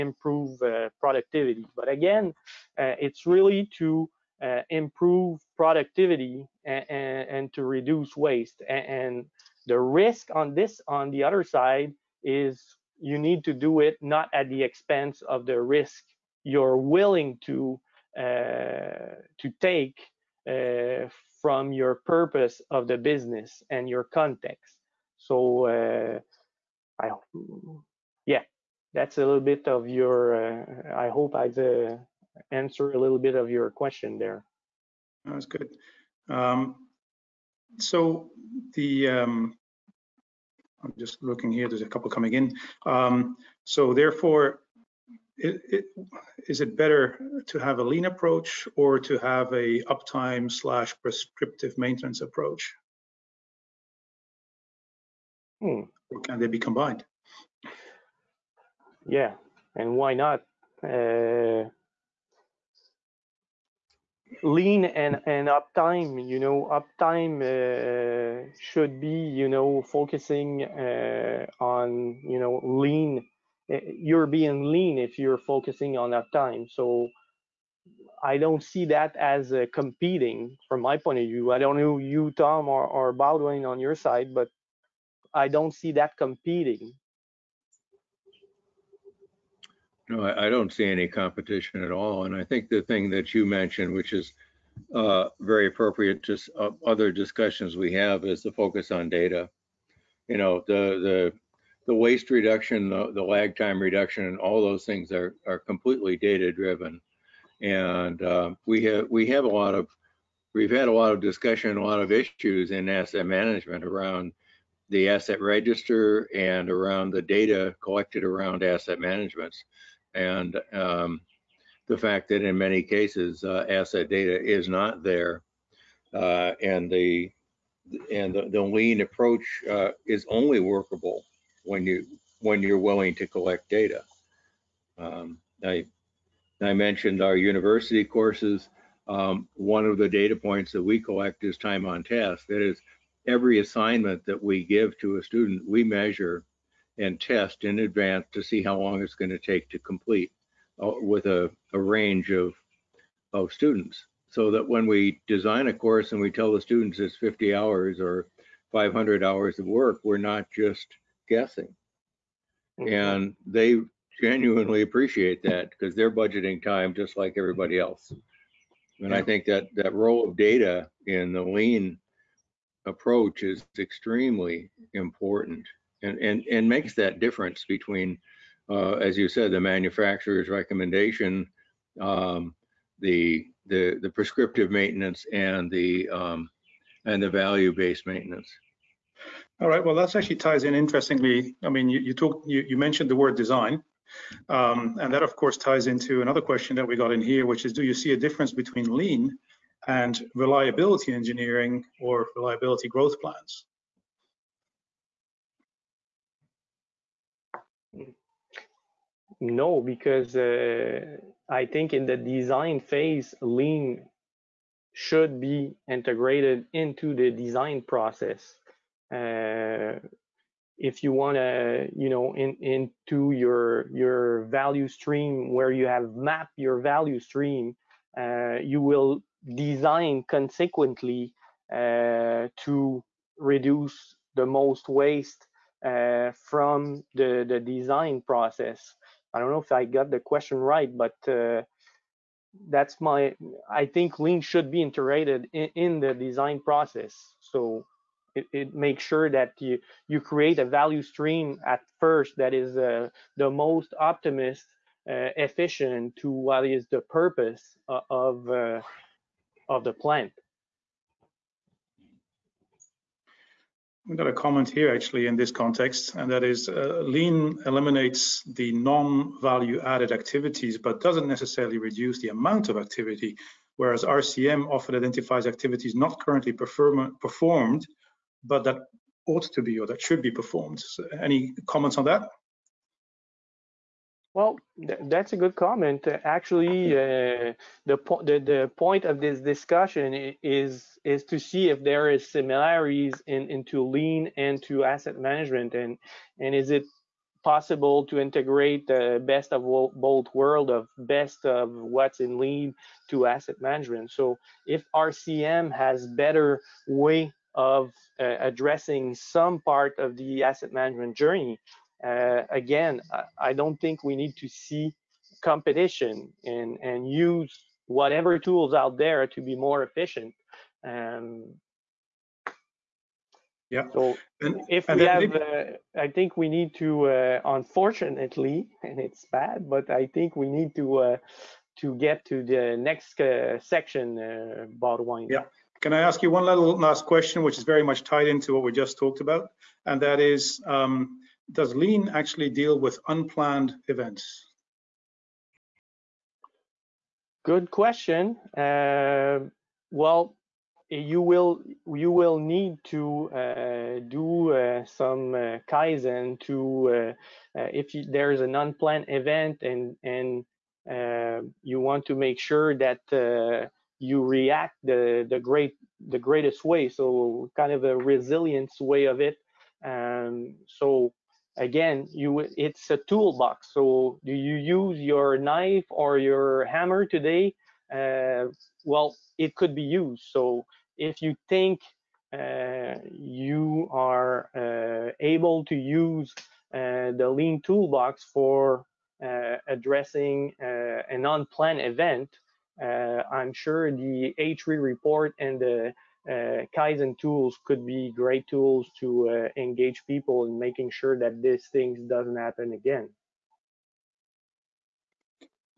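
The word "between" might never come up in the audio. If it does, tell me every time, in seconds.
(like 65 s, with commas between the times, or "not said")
177 s, 198 s.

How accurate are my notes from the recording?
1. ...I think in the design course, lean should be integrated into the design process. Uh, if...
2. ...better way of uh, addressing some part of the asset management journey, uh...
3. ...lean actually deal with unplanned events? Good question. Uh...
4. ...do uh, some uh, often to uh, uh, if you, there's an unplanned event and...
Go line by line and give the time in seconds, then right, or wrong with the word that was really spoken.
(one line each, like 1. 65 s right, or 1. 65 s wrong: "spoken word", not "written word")
1. 211 s wrong: "phase", not "course"
2. 306 s right
3. 341 s right
4. 354 s wrong: "kaizen", not "often".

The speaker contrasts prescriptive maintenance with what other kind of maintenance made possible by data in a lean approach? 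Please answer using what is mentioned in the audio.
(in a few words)
value-based maintenance.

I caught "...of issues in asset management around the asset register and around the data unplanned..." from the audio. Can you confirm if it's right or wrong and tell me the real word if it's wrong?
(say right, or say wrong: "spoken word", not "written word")
wrong: "collected", not "unplanned".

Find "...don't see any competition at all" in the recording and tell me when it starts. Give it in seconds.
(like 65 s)
90 s.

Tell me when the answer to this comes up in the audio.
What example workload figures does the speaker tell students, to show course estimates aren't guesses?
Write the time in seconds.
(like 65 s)
157 s.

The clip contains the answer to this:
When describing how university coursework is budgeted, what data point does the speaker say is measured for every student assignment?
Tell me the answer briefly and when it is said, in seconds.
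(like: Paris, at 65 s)
time on task, at 141 s.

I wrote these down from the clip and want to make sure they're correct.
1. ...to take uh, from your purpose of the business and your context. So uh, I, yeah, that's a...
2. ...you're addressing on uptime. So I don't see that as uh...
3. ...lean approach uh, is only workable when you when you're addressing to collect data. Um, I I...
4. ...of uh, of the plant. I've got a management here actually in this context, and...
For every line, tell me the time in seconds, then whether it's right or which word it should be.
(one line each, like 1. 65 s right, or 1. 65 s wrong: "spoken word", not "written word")
1. 19 s right
2. 75 s wrong: "focusing", not "addressing"
3. 128 s wrong: "willing", not "addressing"
4. 258 s wrong: "comment", not "management".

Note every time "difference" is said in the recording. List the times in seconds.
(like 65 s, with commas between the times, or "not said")
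177 s, 198 s.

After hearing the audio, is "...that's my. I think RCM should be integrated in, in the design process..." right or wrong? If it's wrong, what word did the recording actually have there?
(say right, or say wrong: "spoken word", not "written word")
wrong: "Lean", not "RCM".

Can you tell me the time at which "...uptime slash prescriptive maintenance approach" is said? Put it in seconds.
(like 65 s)
49 s.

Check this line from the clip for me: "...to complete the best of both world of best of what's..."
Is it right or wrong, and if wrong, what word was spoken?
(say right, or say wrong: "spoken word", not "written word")
wrong: "integrate", not "complete".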